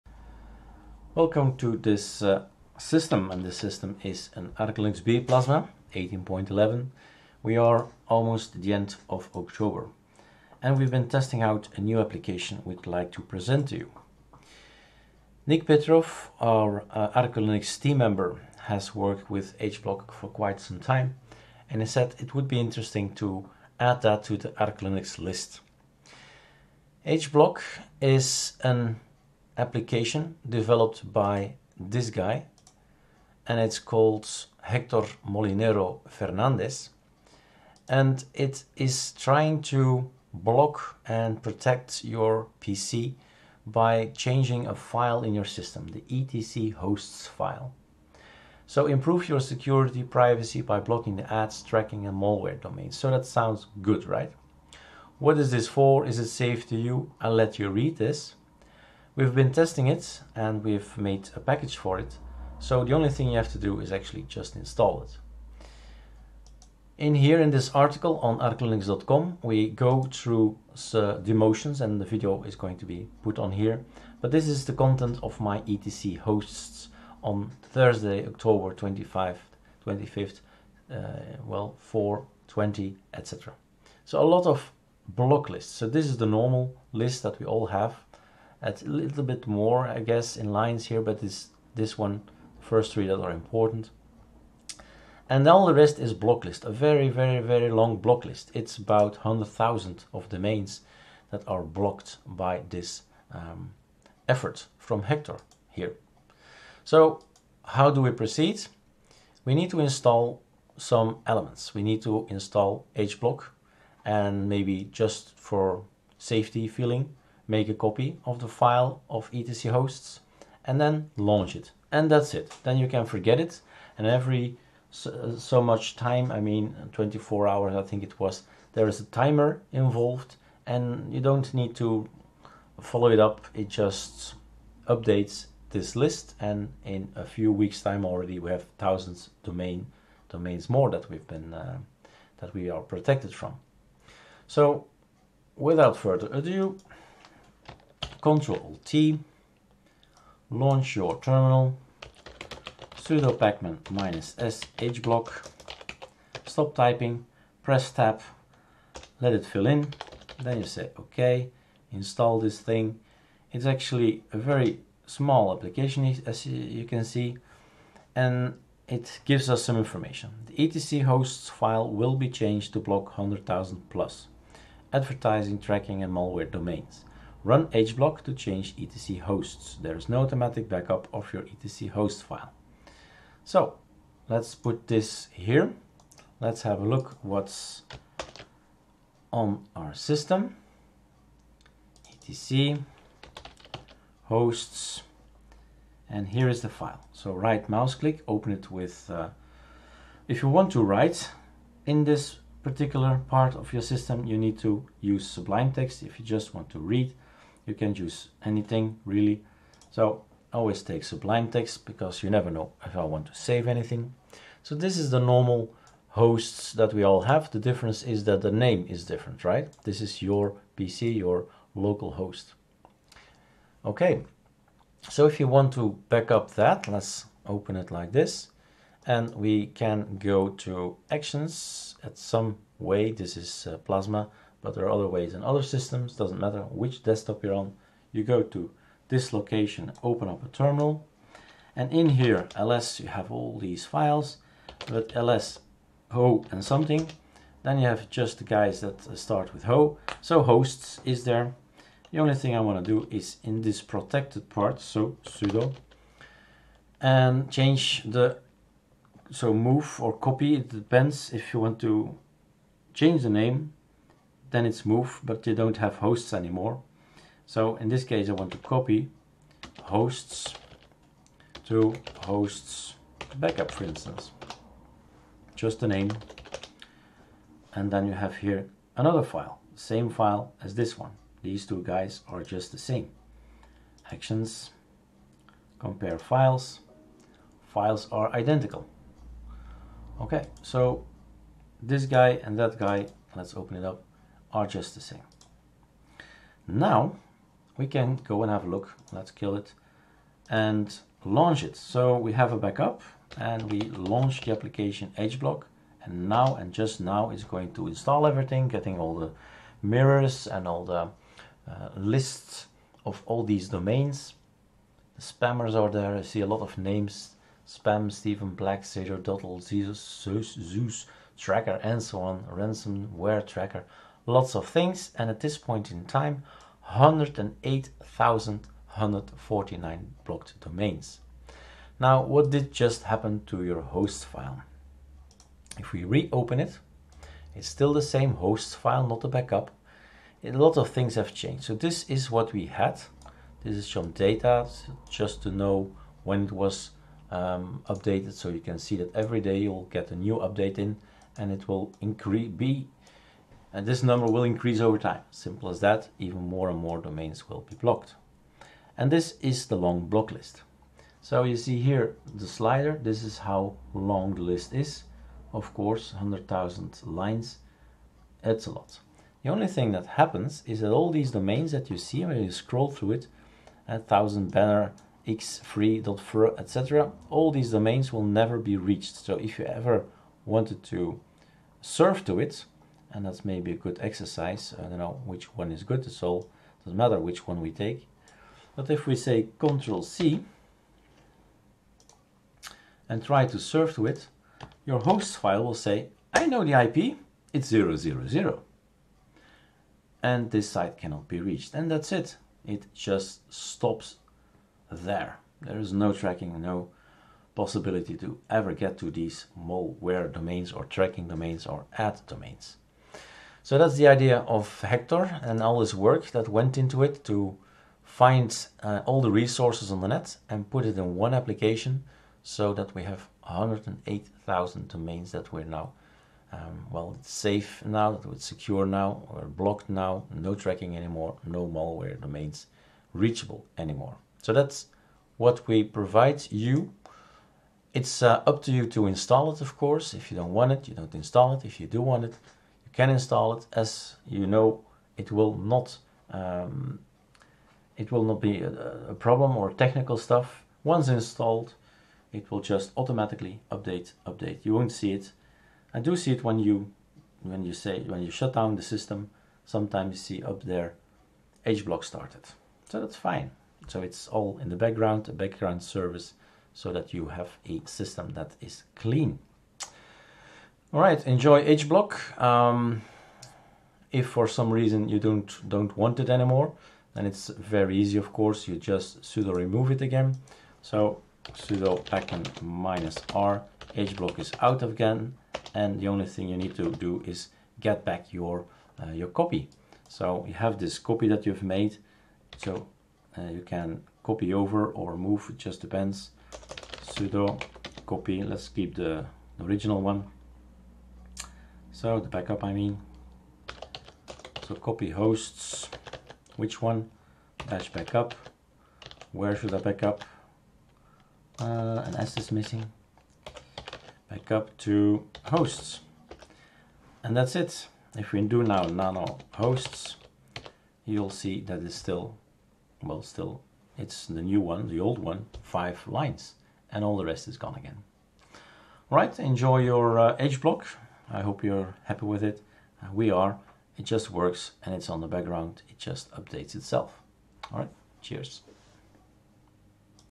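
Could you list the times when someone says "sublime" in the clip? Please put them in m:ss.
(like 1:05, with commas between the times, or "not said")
3:25, 3:31.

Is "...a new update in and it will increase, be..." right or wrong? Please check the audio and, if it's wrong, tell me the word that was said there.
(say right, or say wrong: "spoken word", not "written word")
right.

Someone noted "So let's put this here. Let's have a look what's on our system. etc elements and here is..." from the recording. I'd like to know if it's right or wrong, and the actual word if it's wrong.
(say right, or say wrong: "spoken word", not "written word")
wrong: "hosts", not "elements".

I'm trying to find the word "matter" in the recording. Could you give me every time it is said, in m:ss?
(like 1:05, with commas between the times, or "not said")
3:56, 6:26.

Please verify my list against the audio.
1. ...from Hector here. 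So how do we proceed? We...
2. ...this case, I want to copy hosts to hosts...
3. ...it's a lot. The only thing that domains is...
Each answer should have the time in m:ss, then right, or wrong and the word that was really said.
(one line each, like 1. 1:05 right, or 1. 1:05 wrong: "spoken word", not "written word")
1. 1:44 right
2. 4:27 right
3. 6:08 wrong: "happens", not "domains".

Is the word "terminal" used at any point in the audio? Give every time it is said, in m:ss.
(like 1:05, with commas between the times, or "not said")
2:31, 4:00.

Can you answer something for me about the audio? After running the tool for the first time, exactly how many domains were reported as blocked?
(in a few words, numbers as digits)
108,149.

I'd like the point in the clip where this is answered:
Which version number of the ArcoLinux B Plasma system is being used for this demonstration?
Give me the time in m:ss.
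0:05.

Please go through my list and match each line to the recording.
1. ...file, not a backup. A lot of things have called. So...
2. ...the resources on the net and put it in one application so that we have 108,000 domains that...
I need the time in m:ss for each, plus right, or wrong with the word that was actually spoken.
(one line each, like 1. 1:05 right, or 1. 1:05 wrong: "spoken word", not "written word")
1. 5:38 wrong: "changed", not "called"
2. 6:59 right.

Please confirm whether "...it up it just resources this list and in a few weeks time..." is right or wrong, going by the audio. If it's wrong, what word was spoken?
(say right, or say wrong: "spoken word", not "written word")
wrong: "updates", not "resources".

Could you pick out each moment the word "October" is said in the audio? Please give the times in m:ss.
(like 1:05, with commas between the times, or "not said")
0:09, 1:18.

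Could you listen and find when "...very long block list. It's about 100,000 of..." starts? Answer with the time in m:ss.
1:37.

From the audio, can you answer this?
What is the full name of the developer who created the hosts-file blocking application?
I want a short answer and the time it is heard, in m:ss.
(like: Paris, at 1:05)
Hector Molinero Fernandez, at 0:34.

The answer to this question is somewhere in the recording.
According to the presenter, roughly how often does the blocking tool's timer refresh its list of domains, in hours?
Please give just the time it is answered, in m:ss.
2:06.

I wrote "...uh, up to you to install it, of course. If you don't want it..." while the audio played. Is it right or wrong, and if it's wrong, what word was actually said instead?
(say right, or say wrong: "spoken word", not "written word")
right.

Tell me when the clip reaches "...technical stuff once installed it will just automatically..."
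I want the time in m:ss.
7:29.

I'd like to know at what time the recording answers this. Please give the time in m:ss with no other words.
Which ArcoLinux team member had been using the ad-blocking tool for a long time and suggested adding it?
0:15.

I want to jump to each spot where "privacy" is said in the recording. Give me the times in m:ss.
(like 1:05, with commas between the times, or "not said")
0:50.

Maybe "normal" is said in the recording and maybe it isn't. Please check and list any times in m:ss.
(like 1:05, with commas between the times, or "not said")
1:26, 3:35.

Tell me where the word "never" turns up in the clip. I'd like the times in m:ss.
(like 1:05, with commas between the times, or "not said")
3:32, 6:18.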